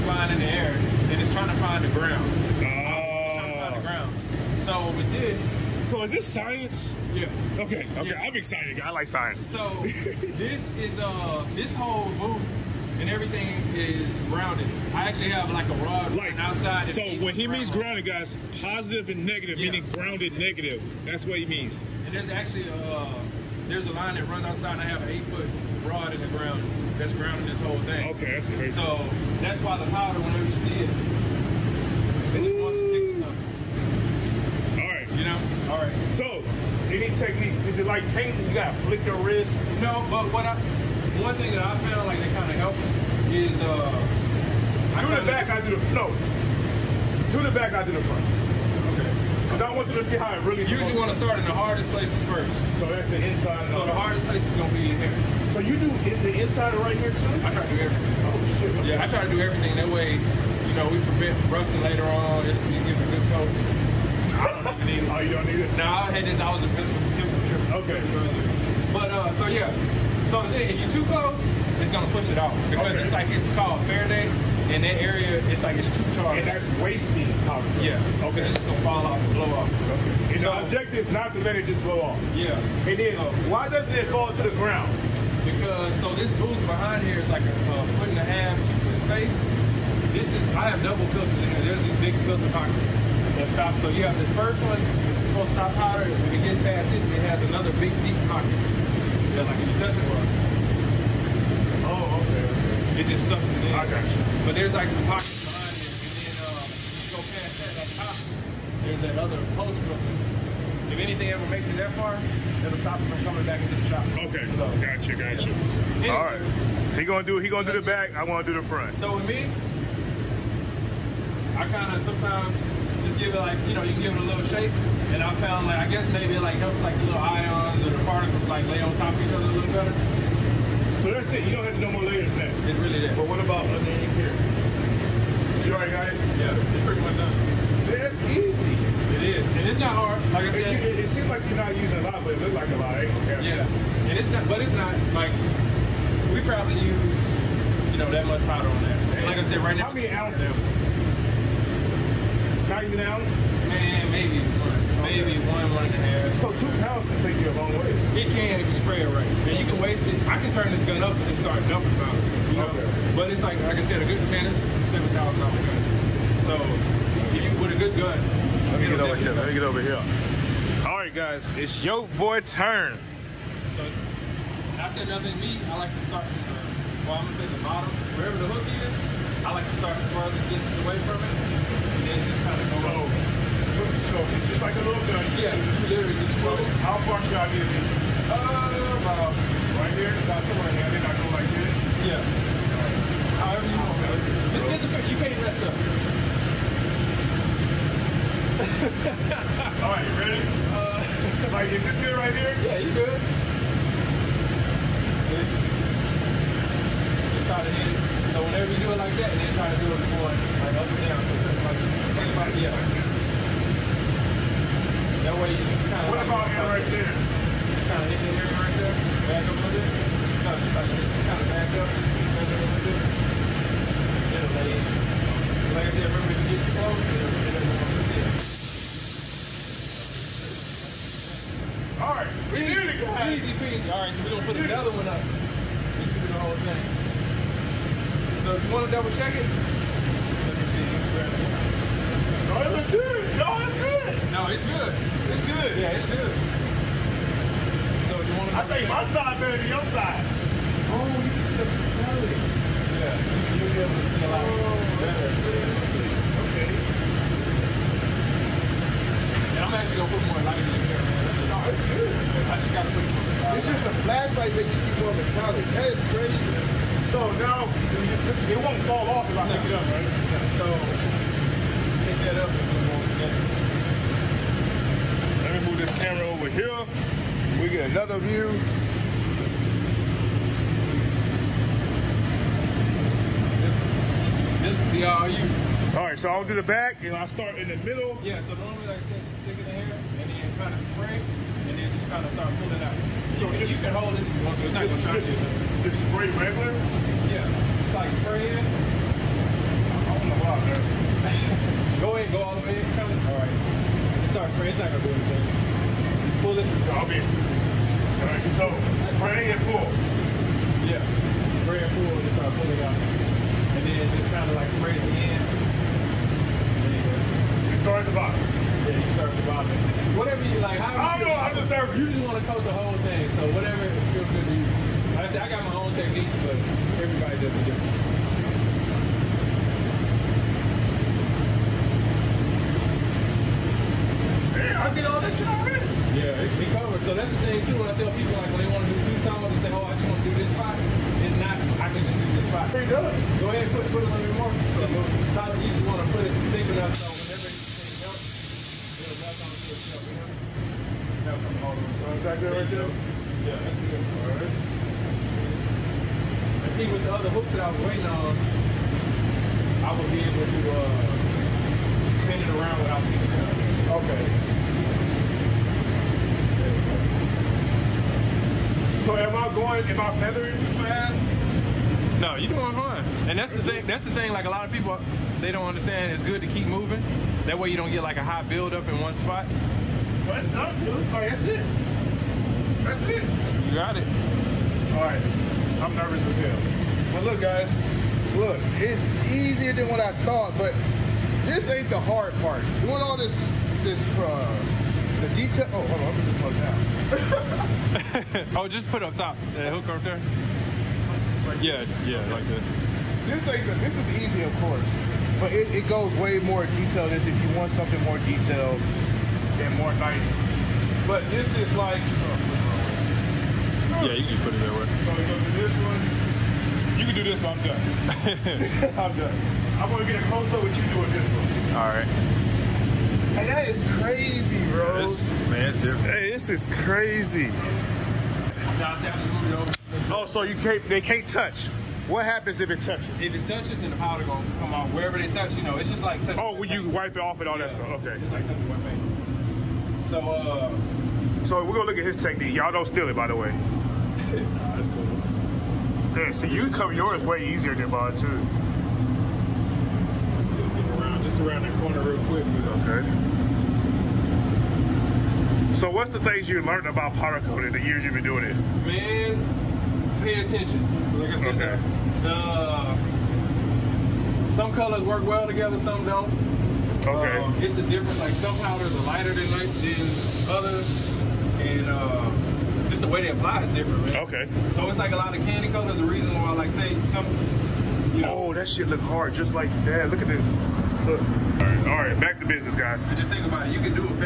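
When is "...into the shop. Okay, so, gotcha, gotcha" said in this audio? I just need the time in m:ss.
1:53.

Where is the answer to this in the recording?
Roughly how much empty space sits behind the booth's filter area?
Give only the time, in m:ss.
1:27.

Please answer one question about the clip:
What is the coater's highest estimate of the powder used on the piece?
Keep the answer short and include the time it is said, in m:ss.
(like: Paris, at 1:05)
1 and a half ounces, at 2:35.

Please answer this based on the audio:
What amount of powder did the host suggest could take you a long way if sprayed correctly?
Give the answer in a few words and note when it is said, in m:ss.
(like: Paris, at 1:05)
2 pounds, at 2:36.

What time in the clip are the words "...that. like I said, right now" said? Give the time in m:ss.
2:28.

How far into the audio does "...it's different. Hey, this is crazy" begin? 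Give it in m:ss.
7:05.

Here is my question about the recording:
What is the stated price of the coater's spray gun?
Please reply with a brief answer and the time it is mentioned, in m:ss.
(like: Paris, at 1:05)
$7,000, at 2:45.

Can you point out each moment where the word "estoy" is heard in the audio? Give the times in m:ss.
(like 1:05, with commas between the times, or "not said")
not said.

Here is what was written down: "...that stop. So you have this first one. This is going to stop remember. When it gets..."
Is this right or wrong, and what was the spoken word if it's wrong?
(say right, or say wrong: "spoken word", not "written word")
wrong: "powder", not "remember".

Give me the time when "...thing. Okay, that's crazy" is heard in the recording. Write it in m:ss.
0:27.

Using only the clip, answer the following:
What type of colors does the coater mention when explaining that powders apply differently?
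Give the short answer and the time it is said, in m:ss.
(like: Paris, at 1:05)
candy colors, at 7:55.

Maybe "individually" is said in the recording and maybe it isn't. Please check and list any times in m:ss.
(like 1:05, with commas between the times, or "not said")
not said.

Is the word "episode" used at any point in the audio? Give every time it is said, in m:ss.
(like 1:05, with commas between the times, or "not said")
not said.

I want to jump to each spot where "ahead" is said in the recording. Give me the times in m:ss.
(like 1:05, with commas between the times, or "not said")
5:02, 5:43.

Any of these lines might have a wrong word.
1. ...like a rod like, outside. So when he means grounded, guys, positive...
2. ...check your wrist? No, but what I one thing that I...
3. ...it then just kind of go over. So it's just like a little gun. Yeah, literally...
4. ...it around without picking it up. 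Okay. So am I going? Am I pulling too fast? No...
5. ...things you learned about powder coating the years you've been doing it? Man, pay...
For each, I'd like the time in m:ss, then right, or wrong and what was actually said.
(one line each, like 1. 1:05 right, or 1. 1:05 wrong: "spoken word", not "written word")
1. 0:15 right
2. 0:38 wrong: "flick", not "check"
3. 3:01 right
4. 6:02 wrong: "feathering", not "pulling"
5. 7:36 right.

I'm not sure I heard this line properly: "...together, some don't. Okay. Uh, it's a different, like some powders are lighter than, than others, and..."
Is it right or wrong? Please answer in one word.
right.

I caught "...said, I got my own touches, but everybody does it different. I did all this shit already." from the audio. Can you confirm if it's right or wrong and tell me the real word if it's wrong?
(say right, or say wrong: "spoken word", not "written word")
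wrong: "techniques", not "touches".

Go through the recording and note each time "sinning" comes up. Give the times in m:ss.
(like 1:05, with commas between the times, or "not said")
not said.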